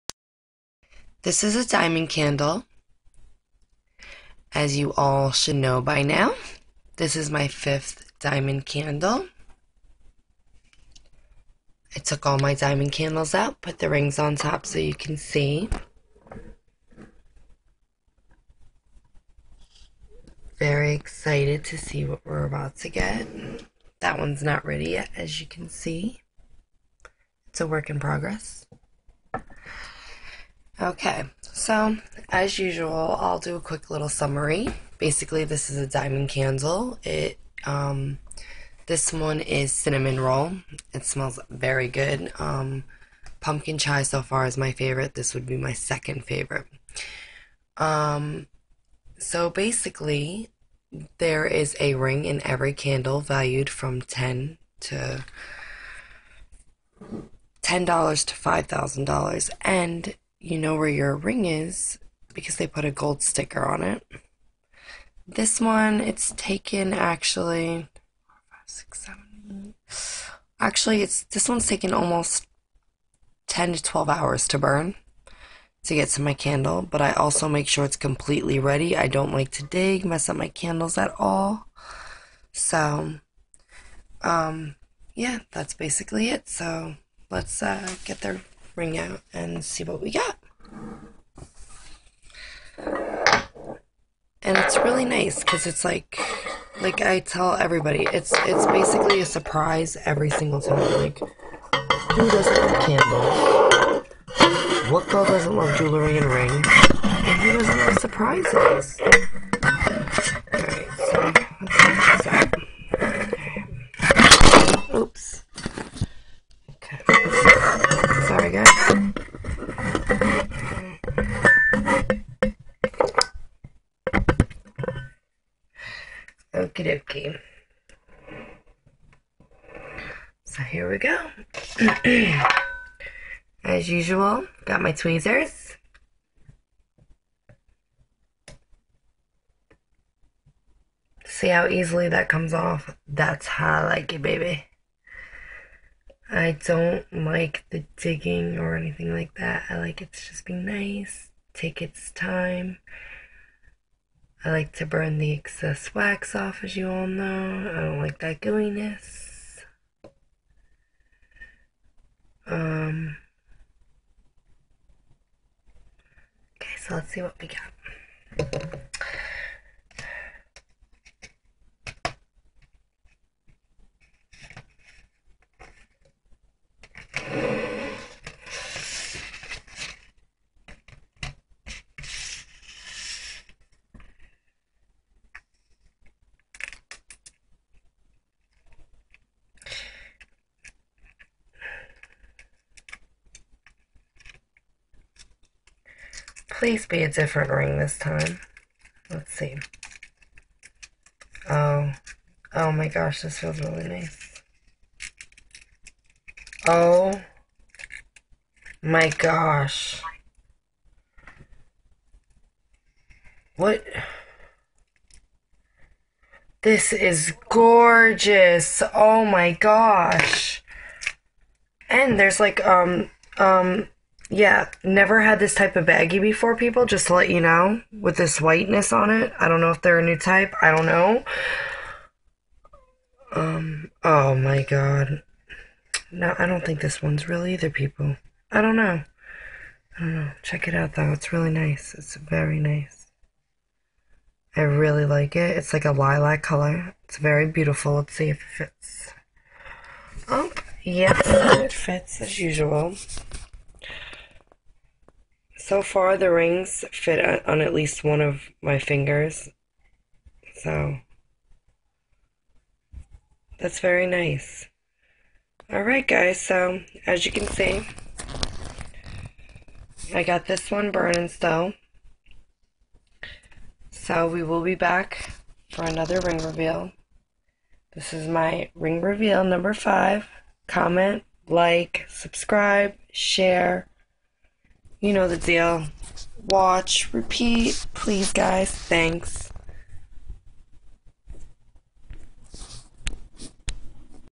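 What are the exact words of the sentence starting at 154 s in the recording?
I like to burn the excess wax off, as you all know.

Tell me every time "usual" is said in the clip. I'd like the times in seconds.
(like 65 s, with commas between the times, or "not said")
32 s, 133 s, 252 s.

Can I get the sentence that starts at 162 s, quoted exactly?
Um, okay, so let's see what we got.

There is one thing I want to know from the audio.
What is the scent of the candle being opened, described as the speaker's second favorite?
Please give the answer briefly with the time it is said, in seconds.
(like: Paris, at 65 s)
Cinnamon roll, at 39 s.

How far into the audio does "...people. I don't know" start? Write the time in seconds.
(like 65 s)
237 s.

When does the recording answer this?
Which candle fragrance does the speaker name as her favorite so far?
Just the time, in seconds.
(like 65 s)
43 s.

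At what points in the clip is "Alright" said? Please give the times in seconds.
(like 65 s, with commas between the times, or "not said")
265 s.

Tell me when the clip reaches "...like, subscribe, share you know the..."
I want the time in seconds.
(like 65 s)
281 s.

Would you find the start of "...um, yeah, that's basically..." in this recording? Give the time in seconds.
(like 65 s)
84 s.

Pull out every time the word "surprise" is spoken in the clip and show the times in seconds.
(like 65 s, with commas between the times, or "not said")
99 s, 107 s.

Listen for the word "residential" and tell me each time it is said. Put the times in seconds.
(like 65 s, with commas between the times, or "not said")
not said.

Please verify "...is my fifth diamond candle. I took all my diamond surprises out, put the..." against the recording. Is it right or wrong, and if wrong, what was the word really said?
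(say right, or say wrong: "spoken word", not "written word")
wrong: "candles", not "surprises".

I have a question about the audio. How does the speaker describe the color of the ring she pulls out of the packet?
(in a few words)
Lilac.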